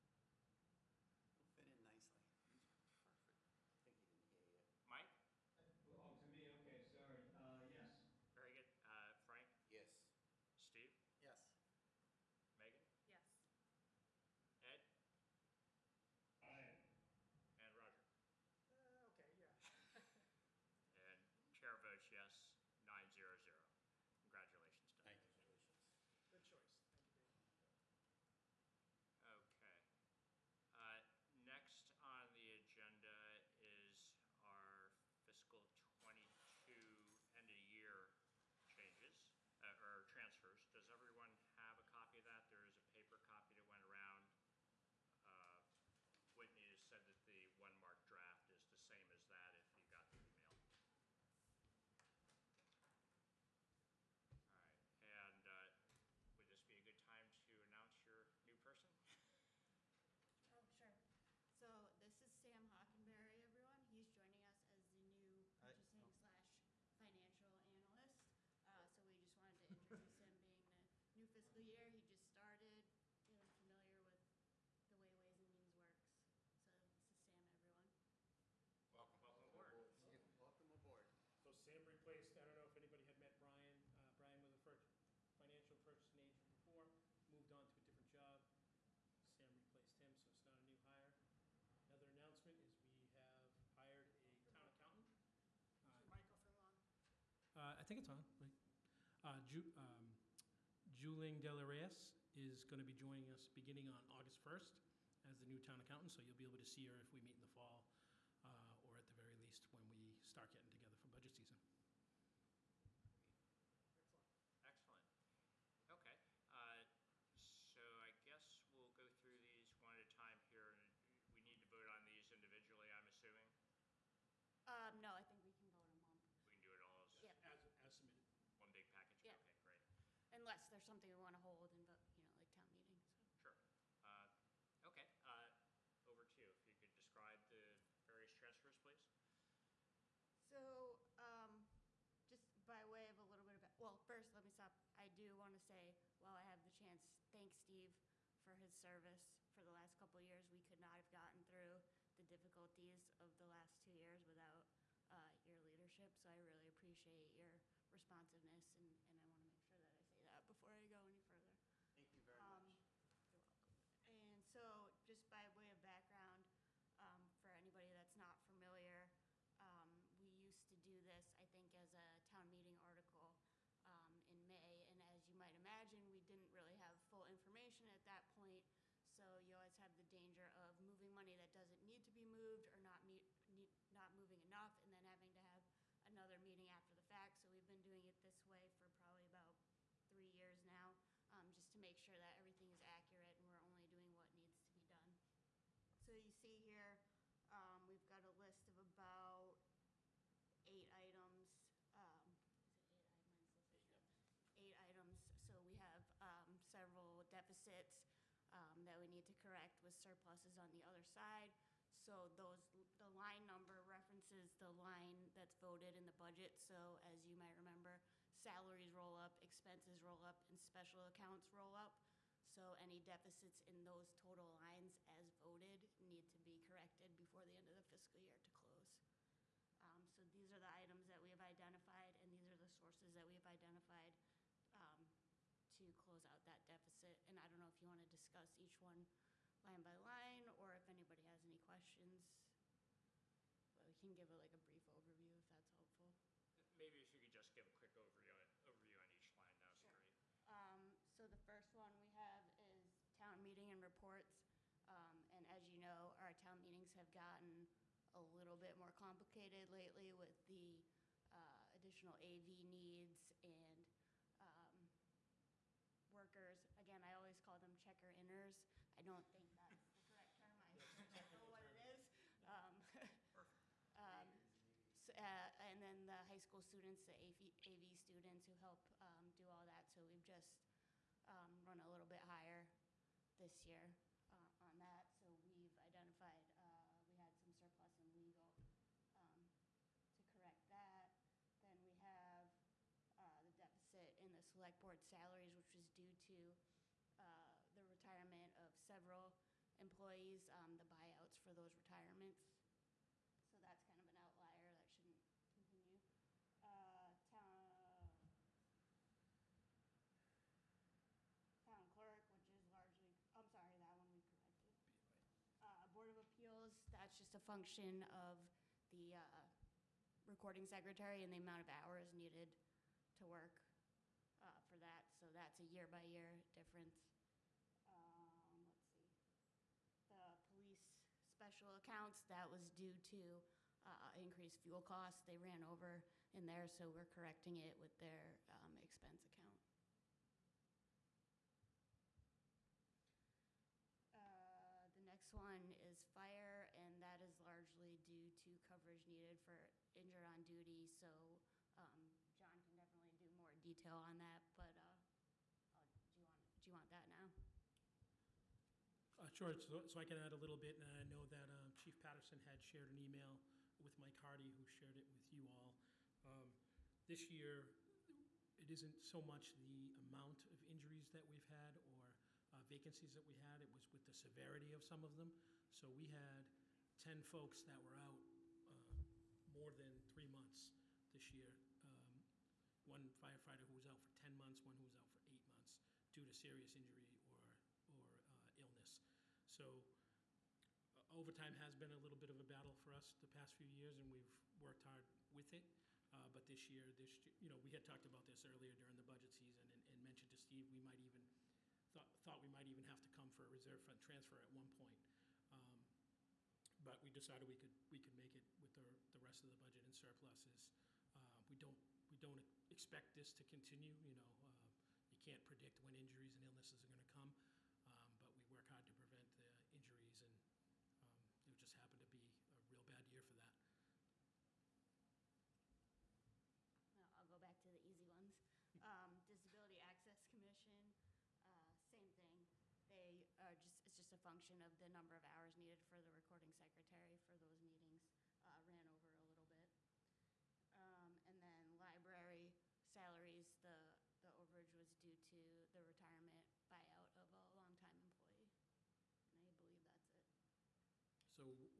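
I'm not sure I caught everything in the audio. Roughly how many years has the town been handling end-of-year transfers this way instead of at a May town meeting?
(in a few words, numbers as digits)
3 years.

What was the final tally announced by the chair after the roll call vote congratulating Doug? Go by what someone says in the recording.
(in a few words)
9-0-0.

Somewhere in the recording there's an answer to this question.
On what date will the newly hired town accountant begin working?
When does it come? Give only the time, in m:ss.
1:44.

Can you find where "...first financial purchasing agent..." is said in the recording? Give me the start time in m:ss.
1:24.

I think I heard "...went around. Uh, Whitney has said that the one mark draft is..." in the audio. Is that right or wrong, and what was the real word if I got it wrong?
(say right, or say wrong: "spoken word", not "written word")
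right.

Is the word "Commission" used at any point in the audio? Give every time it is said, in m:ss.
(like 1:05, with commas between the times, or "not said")
7:10.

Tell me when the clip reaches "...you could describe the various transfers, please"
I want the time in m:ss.
2:16.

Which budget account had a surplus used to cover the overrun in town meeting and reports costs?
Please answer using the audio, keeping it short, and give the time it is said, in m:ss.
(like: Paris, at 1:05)
Legal, at 4:48.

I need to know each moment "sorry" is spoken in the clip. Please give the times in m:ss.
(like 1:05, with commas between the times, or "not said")
0:06, 5:13.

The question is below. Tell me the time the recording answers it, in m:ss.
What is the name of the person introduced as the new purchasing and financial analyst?
1:02.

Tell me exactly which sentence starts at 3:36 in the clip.
So as you might remember, salaries roll up, expenses roll up, and special accounts roll up.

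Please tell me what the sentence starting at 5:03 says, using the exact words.
So that's kind of an outlier that shouldn't continue.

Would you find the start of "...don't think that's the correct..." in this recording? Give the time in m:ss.
4:29.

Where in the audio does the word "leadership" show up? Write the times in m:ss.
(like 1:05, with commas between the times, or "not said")
2:35.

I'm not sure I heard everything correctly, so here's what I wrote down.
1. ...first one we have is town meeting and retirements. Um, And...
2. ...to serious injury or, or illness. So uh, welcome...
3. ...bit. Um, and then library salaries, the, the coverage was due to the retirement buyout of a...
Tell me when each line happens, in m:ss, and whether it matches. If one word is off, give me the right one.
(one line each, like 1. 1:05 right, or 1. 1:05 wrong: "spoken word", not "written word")
1. 4:11 wrong: "reports", not "retirements"
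2. 6:26 wrong: "overtime", not "welcome"
3. 7:19 wrong: "overage", not "coverage".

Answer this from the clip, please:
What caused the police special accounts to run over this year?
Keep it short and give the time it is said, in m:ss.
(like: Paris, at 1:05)
Increased fuel costs, at 5:34.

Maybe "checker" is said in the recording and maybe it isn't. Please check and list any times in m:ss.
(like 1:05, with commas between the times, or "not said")
4:27.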